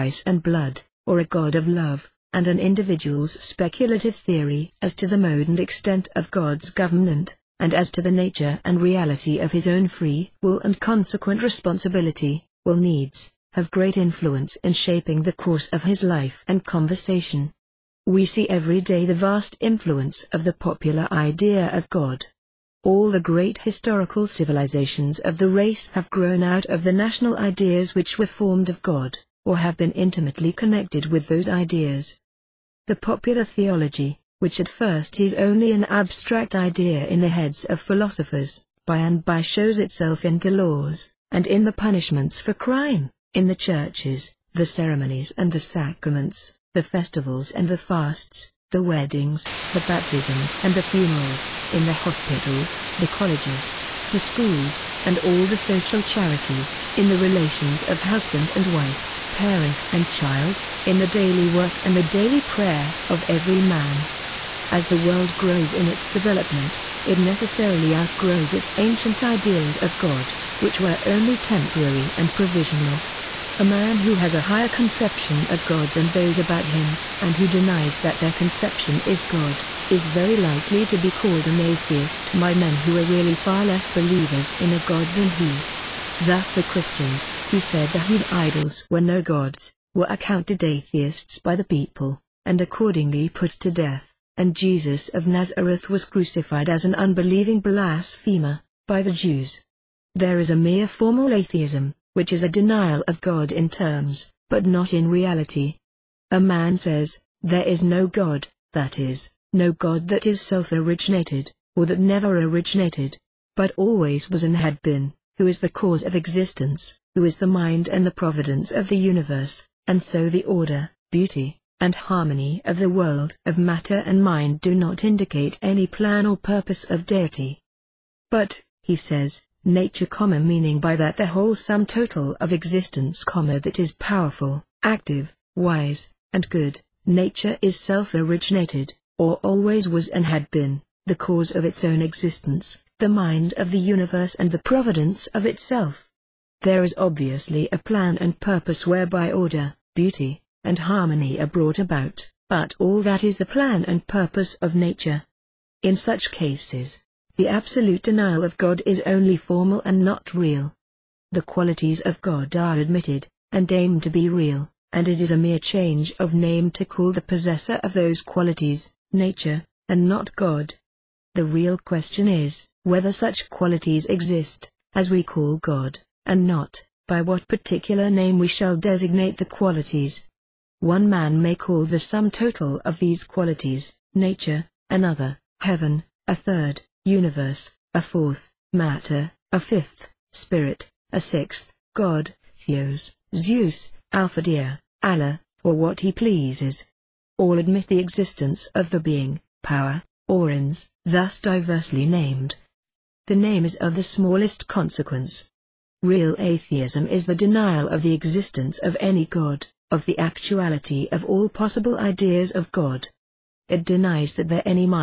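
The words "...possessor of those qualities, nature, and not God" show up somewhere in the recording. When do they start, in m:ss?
2:47.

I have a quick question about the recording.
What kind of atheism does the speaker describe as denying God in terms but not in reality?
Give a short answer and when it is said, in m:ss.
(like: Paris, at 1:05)
formal atheism, at 1:40.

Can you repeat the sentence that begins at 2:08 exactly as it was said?
But, he says, nature, comma, meaning by that the whole sum total of existence, comma, that is powerful, active, wise, and good.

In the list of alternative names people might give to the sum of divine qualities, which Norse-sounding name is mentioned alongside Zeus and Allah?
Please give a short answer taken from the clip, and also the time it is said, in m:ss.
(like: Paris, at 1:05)
Alfadir, at 3:14.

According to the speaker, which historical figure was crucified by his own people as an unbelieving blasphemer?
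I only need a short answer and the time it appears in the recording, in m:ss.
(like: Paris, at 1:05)
Jesus of Nazareth, at 1:34.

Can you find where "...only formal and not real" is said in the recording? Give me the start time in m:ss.
2:39.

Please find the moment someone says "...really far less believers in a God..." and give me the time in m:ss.
1:23.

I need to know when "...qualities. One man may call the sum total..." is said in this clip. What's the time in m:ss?
2:59.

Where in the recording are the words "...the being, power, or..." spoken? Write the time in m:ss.
3:18.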